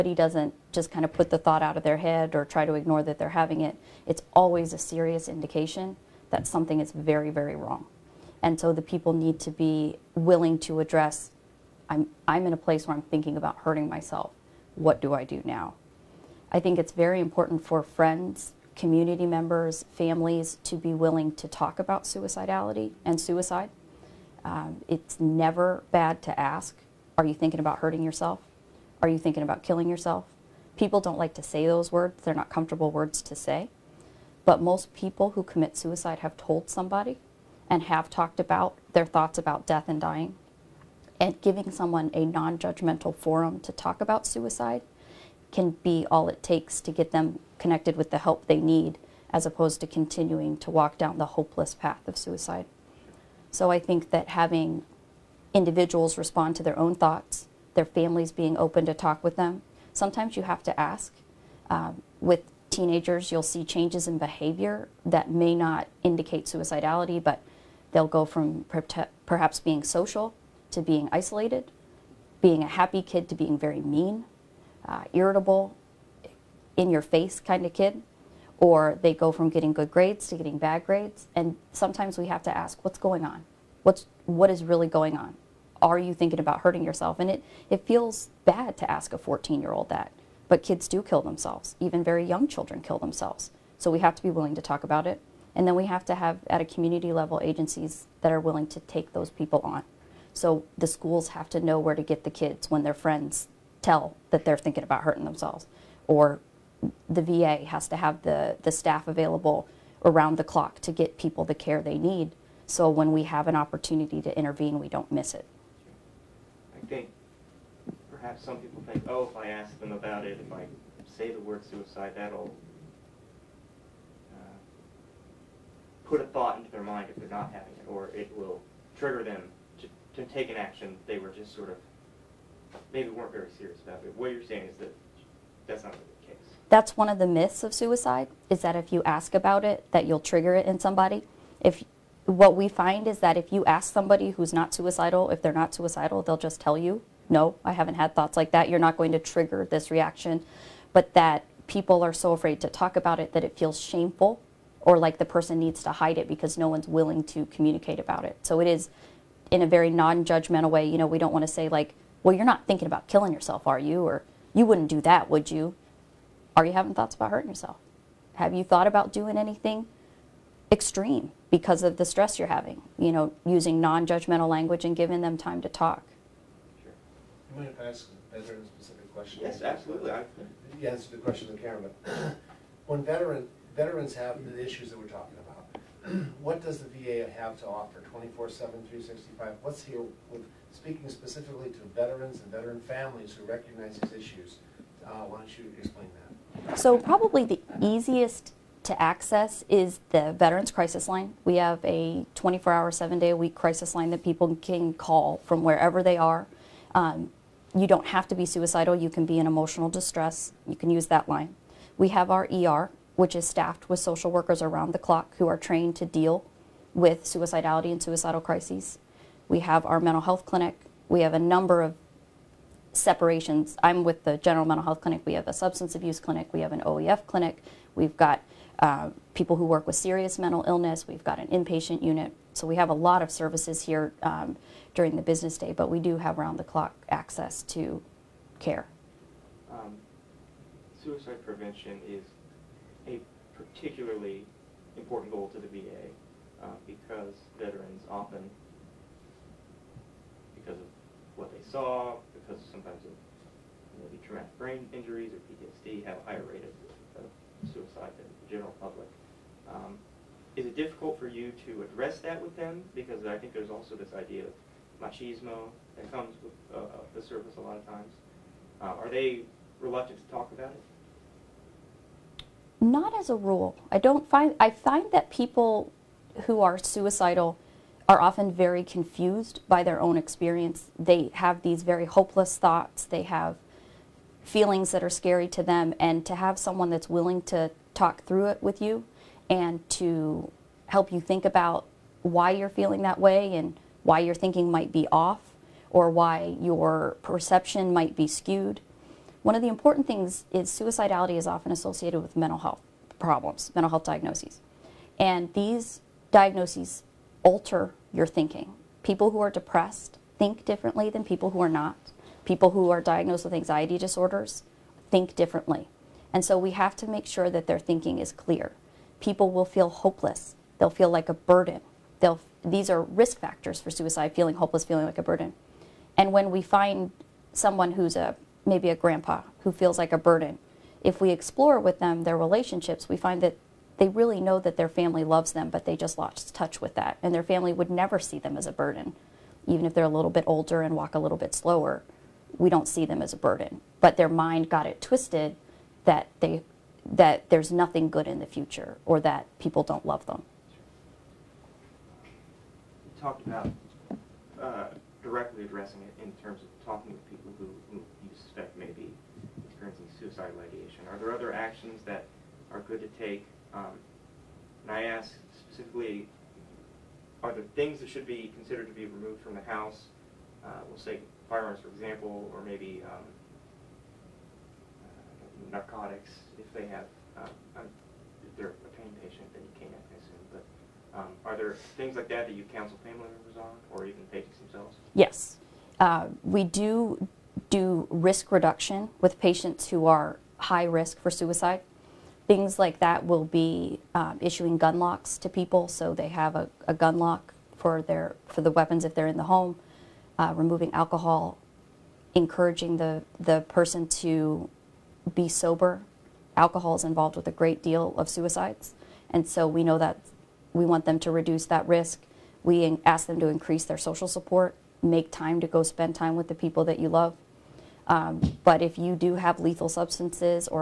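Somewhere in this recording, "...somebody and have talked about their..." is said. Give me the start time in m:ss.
0:36.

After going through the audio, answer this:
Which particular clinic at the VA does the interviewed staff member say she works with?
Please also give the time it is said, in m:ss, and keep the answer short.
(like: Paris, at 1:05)
General mental health clinic, at 3:44.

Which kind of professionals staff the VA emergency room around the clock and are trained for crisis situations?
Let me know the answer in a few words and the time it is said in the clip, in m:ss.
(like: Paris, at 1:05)
Social workers, at 3:33.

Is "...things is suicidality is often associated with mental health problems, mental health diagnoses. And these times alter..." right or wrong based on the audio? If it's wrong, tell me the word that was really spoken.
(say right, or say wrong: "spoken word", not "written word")
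wrong: "diagnoses", not "times".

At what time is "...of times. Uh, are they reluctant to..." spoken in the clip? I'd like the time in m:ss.
4:27.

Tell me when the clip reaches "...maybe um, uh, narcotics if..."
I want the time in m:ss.
6:12.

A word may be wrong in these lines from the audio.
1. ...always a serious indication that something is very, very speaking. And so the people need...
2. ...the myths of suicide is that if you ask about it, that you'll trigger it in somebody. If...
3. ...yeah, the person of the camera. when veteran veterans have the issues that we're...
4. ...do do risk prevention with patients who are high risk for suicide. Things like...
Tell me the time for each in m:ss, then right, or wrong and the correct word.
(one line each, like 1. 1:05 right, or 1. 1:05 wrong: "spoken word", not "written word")
1. 0:04 wrong: "wrong", not "speaking"
2. 2:17 right
3. 3:00 wrong: "question", not "person"
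4. 6:26 wrong: "reduction", not "prevention".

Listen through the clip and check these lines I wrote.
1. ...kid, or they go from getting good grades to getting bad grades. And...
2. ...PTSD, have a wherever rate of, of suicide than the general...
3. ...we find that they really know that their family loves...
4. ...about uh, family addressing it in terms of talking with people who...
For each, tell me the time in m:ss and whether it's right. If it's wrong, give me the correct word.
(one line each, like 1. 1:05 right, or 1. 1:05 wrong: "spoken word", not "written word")
1. 1:17 right
2. 4:15 wrong: "higher", not "wherever"
3. 5:33 right
4. 5:53 wrong: "directly", not "family".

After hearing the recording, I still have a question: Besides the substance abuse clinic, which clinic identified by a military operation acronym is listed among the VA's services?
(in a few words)
OEF clinic.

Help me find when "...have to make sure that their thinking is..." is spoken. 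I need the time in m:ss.
5:16.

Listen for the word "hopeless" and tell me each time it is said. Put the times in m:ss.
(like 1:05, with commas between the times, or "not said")
0:51, 4:42, 5:19, 5:24.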